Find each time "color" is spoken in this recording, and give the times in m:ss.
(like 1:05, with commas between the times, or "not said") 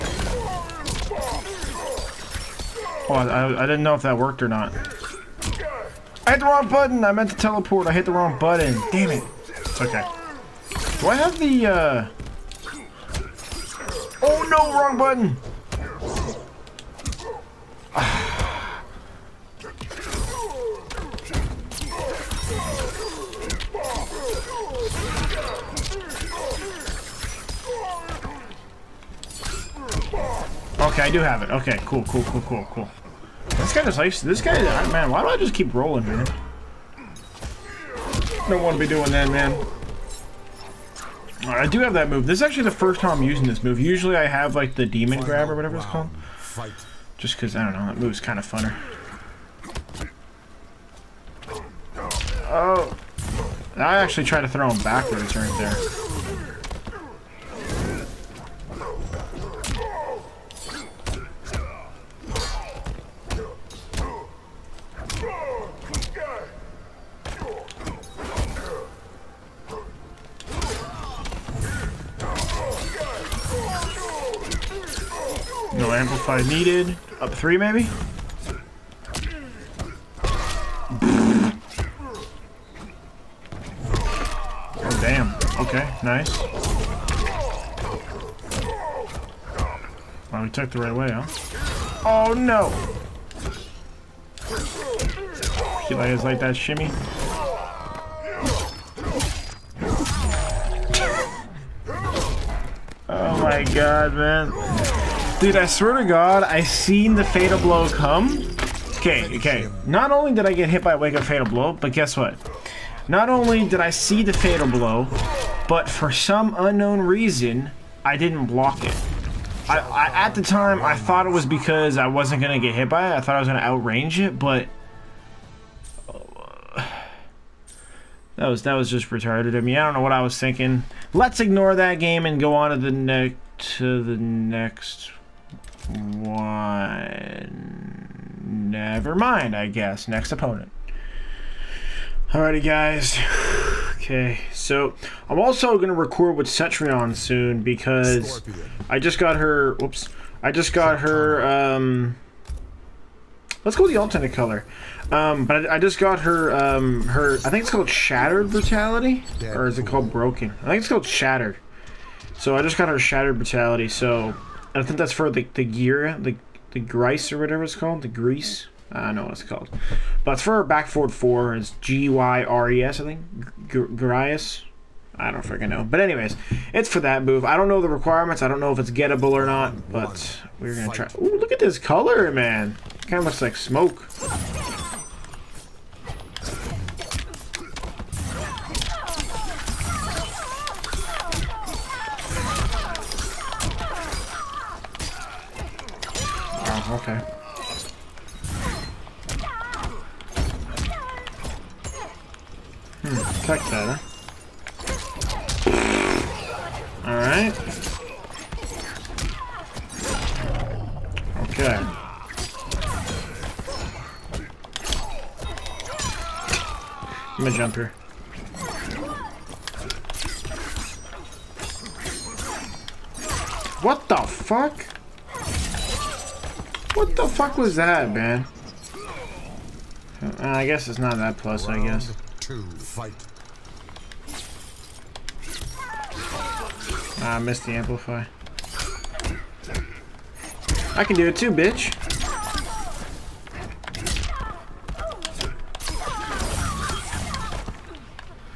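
2:34, 3:01.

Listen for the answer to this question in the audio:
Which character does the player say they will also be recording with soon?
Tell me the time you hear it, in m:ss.
2:26.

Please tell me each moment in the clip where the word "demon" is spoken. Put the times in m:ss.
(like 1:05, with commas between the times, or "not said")
0:44.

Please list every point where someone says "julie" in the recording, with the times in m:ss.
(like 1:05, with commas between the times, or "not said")
not said.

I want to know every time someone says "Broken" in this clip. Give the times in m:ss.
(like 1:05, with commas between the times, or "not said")
2:40.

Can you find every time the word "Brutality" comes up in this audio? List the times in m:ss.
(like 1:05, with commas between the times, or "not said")
2:38, 2:43.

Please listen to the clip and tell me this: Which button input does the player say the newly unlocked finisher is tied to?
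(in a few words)
back four.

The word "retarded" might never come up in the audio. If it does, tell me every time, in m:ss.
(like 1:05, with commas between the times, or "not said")
2:09.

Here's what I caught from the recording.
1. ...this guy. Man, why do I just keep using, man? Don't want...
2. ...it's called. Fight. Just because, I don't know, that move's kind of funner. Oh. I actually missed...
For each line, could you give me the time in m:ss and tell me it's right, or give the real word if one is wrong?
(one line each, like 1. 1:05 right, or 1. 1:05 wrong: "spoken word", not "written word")
1. 0:34 wrong: "rolling", not "using"
2. 0:45 wrong: "tried", not "missed".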